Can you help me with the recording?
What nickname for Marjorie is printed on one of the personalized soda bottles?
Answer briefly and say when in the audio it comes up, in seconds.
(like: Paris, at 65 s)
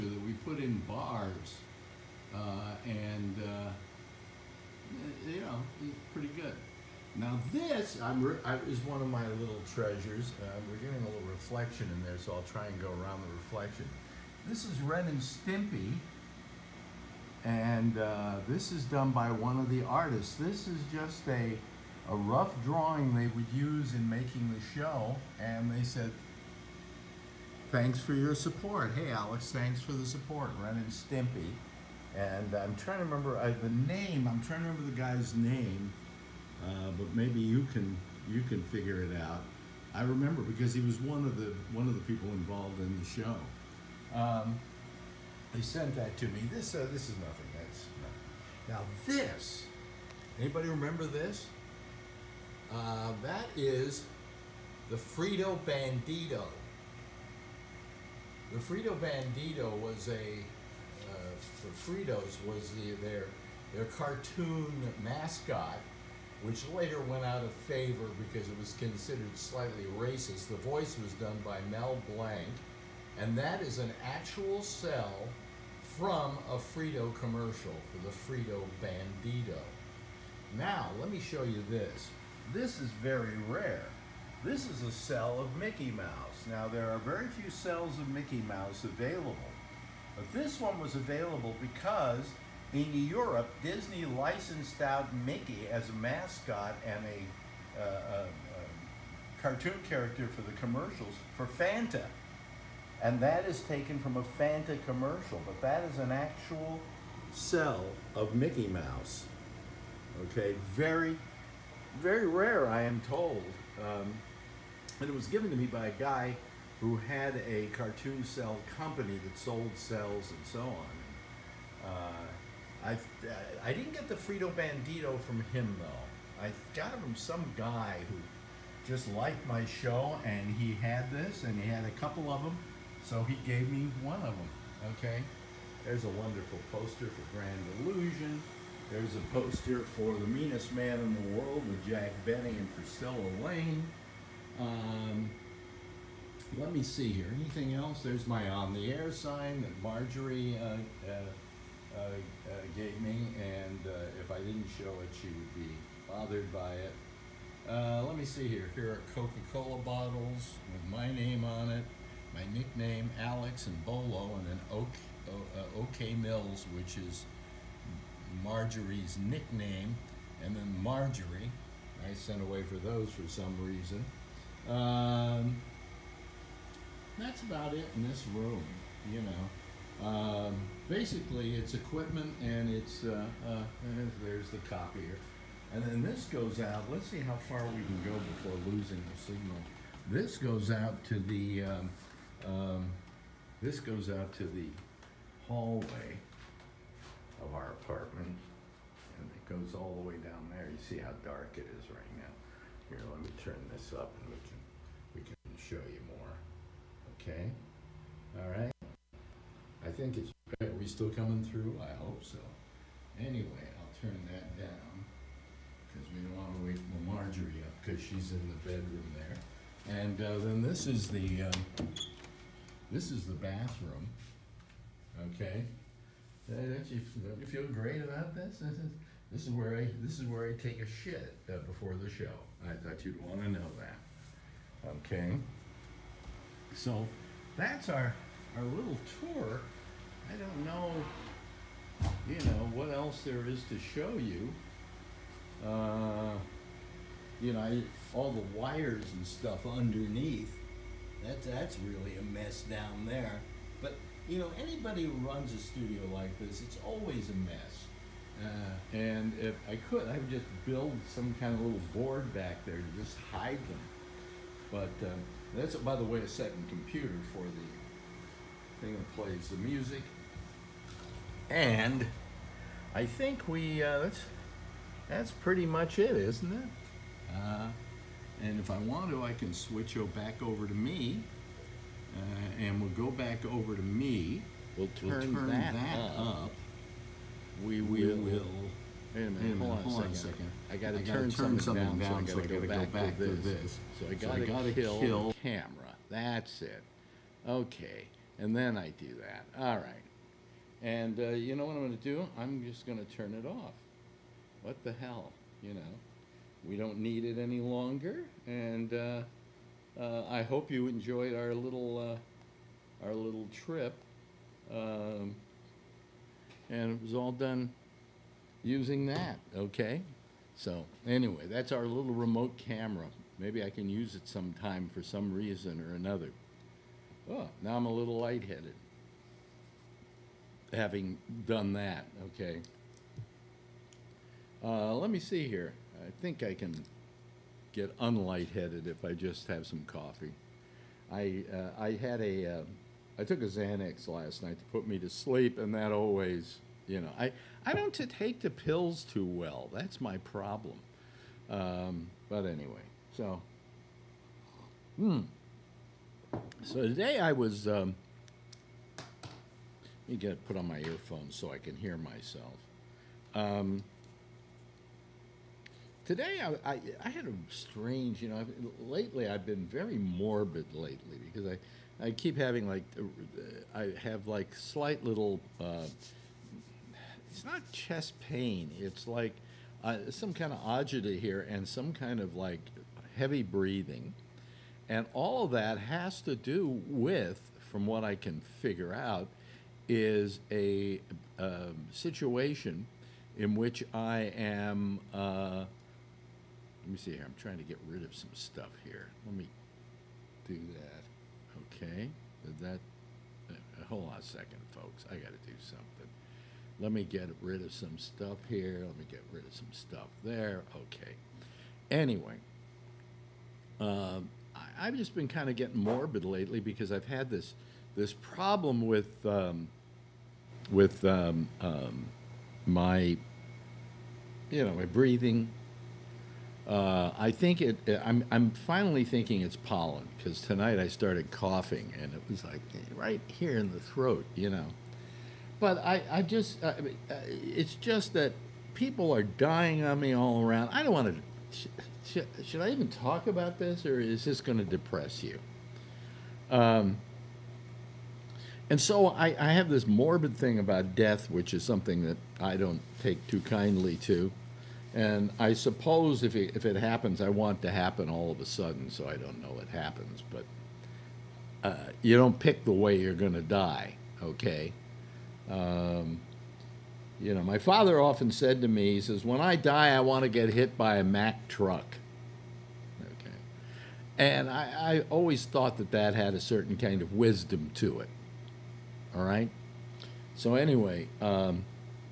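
OK Mills, at 165 s.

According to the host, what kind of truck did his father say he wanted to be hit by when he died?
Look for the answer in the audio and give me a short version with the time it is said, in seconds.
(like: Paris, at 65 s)
Mack truck, at 471 s.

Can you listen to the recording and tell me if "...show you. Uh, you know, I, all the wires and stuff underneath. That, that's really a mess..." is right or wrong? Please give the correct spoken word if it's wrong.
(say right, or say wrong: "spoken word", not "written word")
right.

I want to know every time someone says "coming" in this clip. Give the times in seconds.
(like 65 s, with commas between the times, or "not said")
211 s.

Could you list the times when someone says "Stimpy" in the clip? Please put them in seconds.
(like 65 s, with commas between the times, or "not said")
15 s, 30 s.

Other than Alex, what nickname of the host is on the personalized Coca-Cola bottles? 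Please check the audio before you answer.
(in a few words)
Bolo.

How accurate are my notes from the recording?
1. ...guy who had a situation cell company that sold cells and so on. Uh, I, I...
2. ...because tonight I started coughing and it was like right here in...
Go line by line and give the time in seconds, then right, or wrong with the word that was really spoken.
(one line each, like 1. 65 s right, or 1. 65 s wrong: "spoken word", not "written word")
1. 115 s wrong: "cartoon", not "situation"
2. 430 s right.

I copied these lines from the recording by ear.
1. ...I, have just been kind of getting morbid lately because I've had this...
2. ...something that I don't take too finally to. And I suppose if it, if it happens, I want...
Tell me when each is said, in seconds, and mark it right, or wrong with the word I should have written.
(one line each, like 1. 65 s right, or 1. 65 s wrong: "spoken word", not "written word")
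1. 414 s right
2. 451 s wrong: "kindly", not "finally".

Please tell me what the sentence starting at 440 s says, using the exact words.
I don't want to should, I even talk about this or is this going to depress you?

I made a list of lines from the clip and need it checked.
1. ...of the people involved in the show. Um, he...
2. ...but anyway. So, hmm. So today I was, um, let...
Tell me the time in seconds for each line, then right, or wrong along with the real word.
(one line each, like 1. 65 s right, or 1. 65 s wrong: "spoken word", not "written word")
1. 41 s right
2. 352 s right.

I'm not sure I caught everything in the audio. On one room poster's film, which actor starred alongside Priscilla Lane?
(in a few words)
Jack Benny.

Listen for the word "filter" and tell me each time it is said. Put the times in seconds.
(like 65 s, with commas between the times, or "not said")
not said.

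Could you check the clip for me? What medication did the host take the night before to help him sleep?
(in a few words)
Xanax.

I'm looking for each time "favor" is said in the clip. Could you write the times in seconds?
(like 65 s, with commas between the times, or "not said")
67 s.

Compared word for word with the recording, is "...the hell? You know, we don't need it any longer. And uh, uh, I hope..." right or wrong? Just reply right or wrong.
right.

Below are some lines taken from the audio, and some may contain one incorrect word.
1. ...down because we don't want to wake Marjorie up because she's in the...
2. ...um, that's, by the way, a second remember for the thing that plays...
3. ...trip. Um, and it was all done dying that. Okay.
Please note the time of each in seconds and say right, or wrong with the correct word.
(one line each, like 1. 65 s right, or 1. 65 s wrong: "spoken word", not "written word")
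1. 214 s right
2. 265 s wrong: "computer", not "remember"
3. 313 s wrong: "using", not "dying".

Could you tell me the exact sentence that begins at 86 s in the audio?
Now, there are very few cells of Mickey Mouse available.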